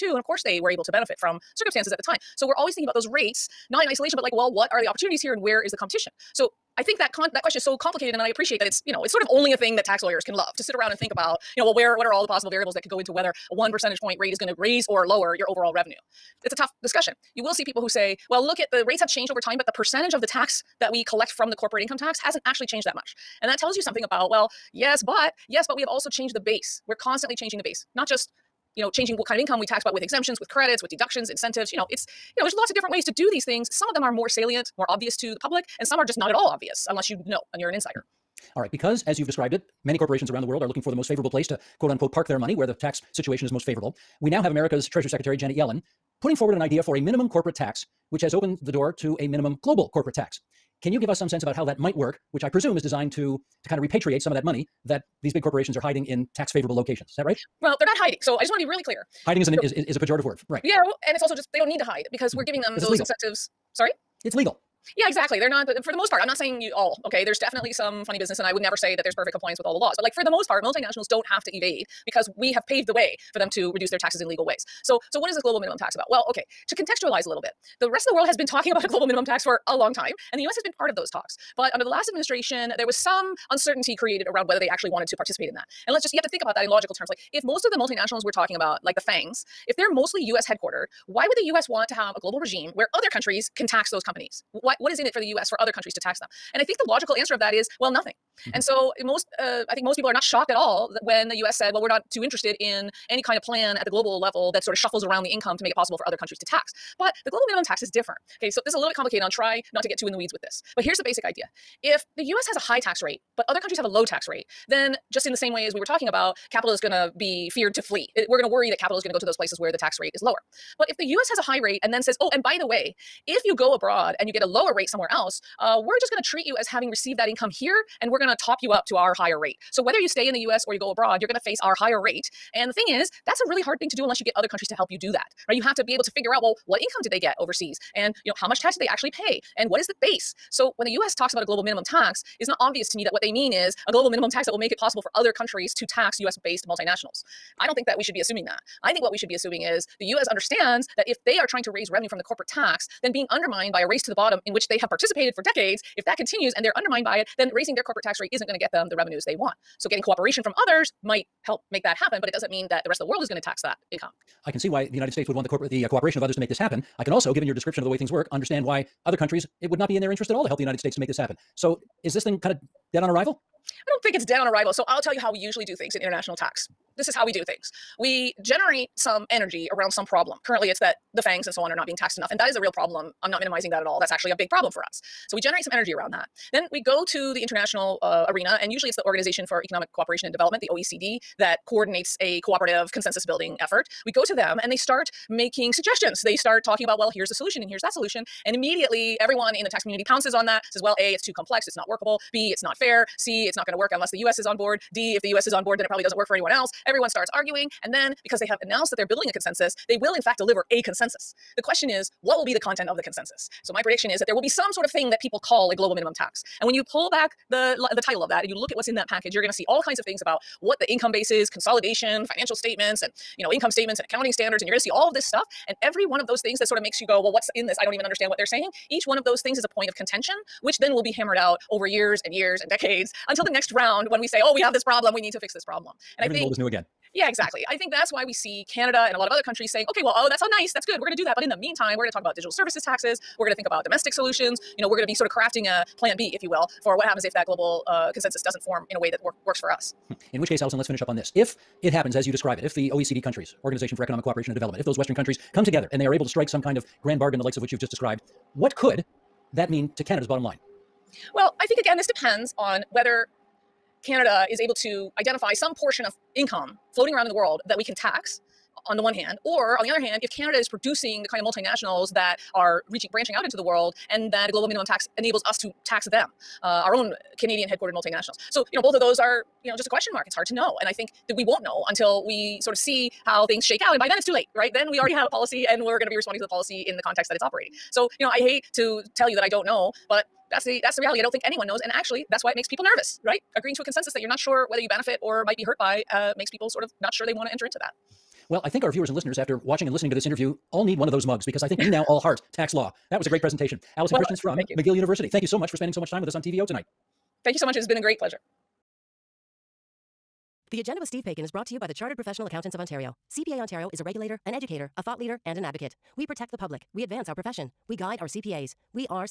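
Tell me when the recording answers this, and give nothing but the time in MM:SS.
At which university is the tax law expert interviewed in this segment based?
05:04.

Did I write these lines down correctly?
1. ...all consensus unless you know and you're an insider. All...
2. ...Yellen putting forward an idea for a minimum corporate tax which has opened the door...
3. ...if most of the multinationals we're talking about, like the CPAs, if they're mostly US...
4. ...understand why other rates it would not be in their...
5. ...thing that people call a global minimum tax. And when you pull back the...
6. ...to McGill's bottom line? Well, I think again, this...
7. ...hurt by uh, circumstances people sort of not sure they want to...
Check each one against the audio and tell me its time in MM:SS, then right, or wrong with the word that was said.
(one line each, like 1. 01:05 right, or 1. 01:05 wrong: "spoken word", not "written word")
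1. 00:36 wrong: "obvious", not "consensus"
2. 00:45 right
3. 01:27 wrong: "FANGs", not "CPAs"
4. 02:48 wrong: "countries", not "rates"
5. 03:34 right
6. 04:19 wrong: "Canada", not "McGill"
7. 04:55 wrong: "makes", not "circumstances".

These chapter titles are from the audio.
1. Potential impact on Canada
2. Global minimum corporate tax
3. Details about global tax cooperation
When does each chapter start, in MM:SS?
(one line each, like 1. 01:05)
1. 04:18
2. 00:57
3. 03:06.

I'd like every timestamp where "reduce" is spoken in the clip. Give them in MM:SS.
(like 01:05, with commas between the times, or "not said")
01:13.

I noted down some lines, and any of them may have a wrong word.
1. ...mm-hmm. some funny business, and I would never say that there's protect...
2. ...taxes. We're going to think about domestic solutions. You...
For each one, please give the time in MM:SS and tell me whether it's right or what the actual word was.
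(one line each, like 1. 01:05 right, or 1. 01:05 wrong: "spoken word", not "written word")
1. 01:07 wrong: "perfect", not "protect"
2. 04:02 right.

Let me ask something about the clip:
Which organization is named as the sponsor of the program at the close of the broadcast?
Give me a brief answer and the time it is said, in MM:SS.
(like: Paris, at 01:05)
Chartered Professional Accountants of Ontario, at 05:11.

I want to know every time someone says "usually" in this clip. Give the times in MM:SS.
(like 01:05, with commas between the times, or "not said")
02:55, 03:08.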